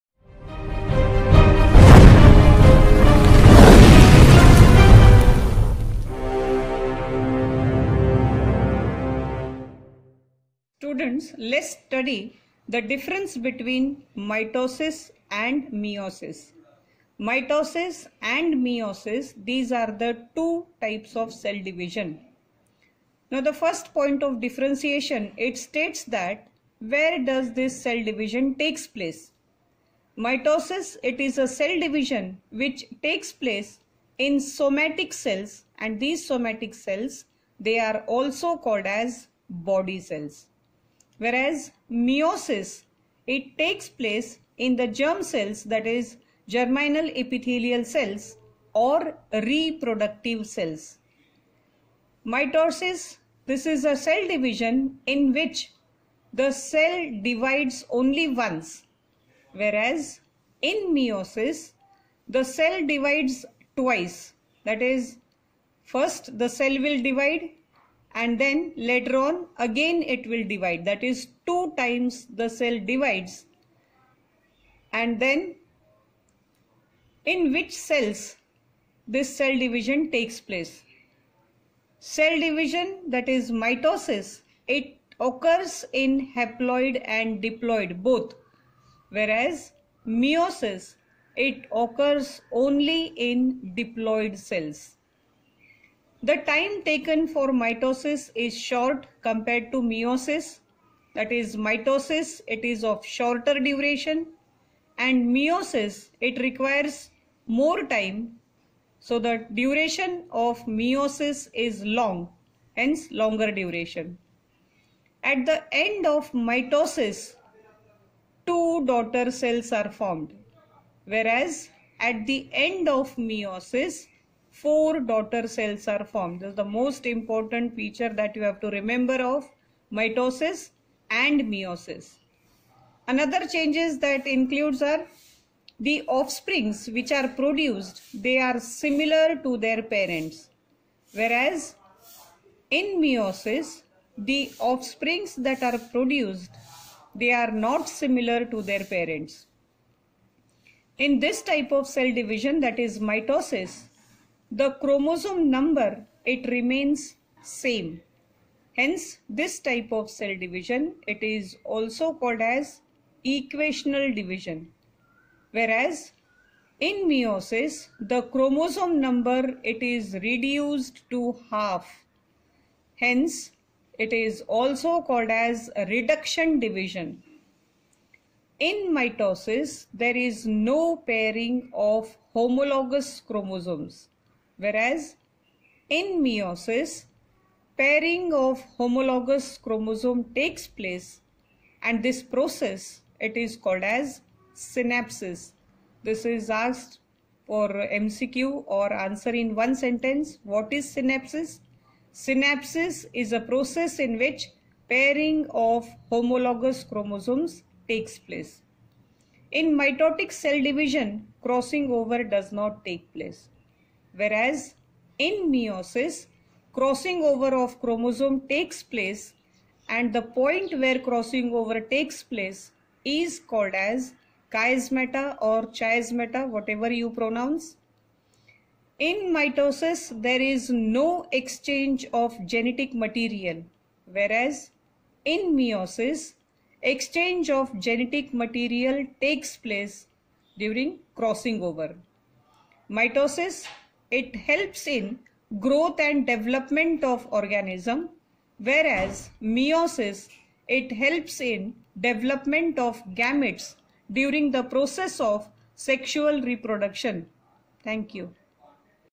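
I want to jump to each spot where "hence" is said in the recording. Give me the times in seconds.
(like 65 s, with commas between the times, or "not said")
112 s, 158 s, 172 s.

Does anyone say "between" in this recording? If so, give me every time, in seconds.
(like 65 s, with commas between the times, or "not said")
13 s.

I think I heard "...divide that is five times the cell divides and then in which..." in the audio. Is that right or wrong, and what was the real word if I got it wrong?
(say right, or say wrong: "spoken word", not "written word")
wrong: "two", not "five".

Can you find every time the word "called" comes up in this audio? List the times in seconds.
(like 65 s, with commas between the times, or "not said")
38 s, 162 s, 175 s, 193 s, 223 s.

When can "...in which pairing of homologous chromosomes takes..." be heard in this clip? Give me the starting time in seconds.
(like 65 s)
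203 s.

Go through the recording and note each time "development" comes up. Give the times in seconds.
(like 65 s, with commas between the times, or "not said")
246 s, 251 s.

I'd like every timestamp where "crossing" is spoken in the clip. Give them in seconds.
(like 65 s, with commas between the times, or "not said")
211 s, 216 s, 220 s, 241 s.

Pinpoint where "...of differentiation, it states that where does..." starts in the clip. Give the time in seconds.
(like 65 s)
24 s.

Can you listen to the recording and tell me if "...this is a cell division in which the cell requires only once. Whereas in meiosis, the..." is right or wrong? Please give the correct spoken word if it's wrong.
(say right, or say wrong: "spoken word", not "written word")
wrong: "divides", not "requires".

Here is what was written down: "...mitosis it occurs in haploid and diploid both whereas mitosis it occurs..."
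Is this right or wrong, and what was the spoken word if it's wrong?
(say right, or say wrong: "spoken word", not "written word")
wrong: "meiosis", not "mitosis".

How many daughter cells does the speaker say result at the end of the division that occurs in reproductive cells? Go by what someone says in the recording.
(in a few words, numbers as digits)
4.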